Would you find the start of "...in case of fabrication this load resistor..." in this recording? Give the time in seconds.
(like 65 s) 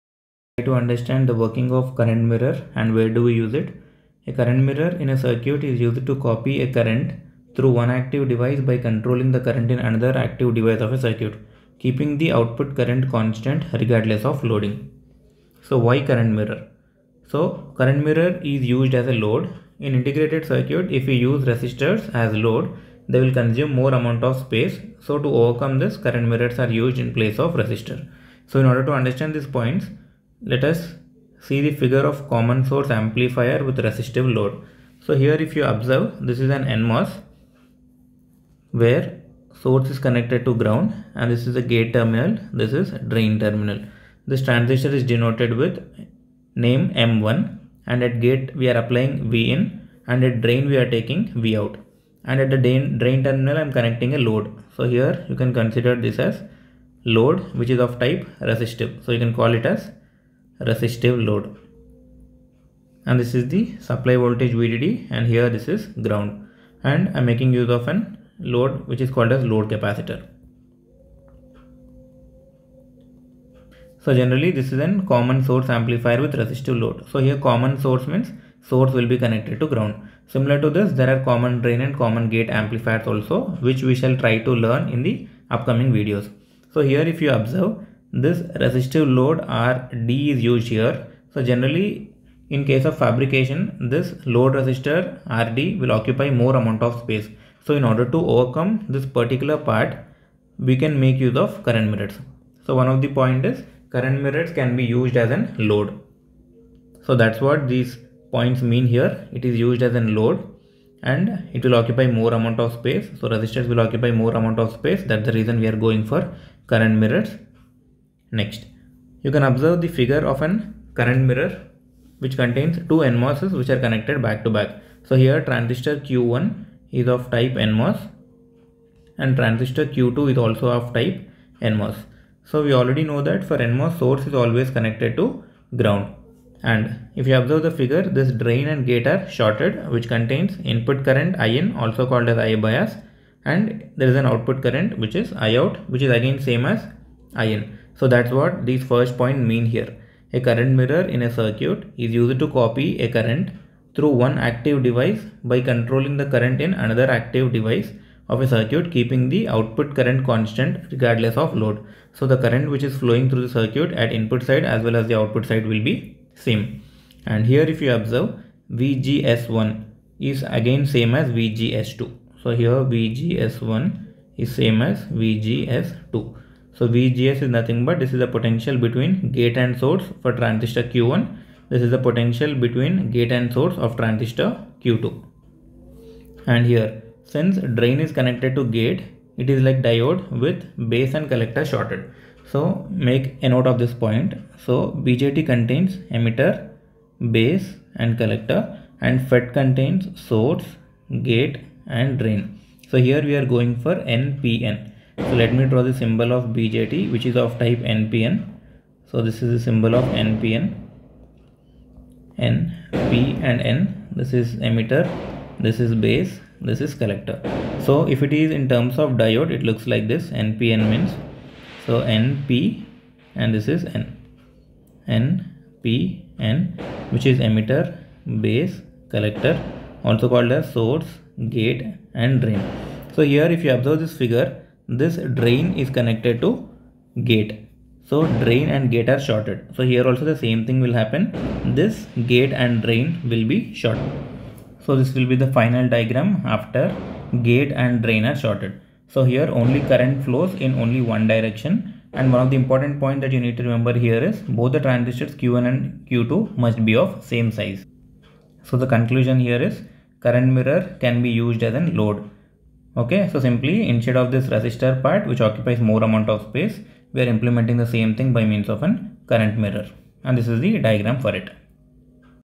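92 s.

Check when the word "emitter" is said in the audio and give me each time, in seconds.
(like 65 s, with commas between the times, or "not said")
196 s, 214 s, 227 s.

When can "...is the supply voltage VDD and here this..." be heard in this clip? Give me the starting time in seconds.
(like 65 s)
63 s.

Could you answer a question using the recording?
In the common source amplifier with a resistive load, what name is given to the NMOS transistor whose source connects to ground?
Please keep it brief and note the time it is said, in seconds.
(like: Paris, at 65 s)
M1, at 46 s.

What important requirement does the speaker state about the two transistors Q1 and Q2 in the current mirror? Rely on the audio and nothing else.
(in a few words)
same size.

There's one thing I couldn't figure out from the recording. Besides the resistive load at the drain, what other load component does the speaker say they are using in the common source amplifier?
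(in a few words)
load capacitor.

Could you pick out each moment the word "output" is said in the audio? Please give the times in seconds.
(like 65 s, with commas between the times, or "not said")
12 s, 144 s, 159 s, 165 s.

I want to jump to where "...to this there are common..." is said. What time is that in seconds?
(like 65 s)
80 s.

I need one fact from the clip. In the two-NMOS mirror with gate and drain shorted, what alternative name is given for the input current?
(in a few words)
I bias.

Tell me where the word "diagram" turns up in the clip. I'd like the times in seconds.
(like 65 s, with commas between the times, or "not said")
245 s, 270 s.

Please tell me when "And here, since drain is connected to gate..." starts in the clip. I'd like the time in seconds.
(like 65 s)
186 s.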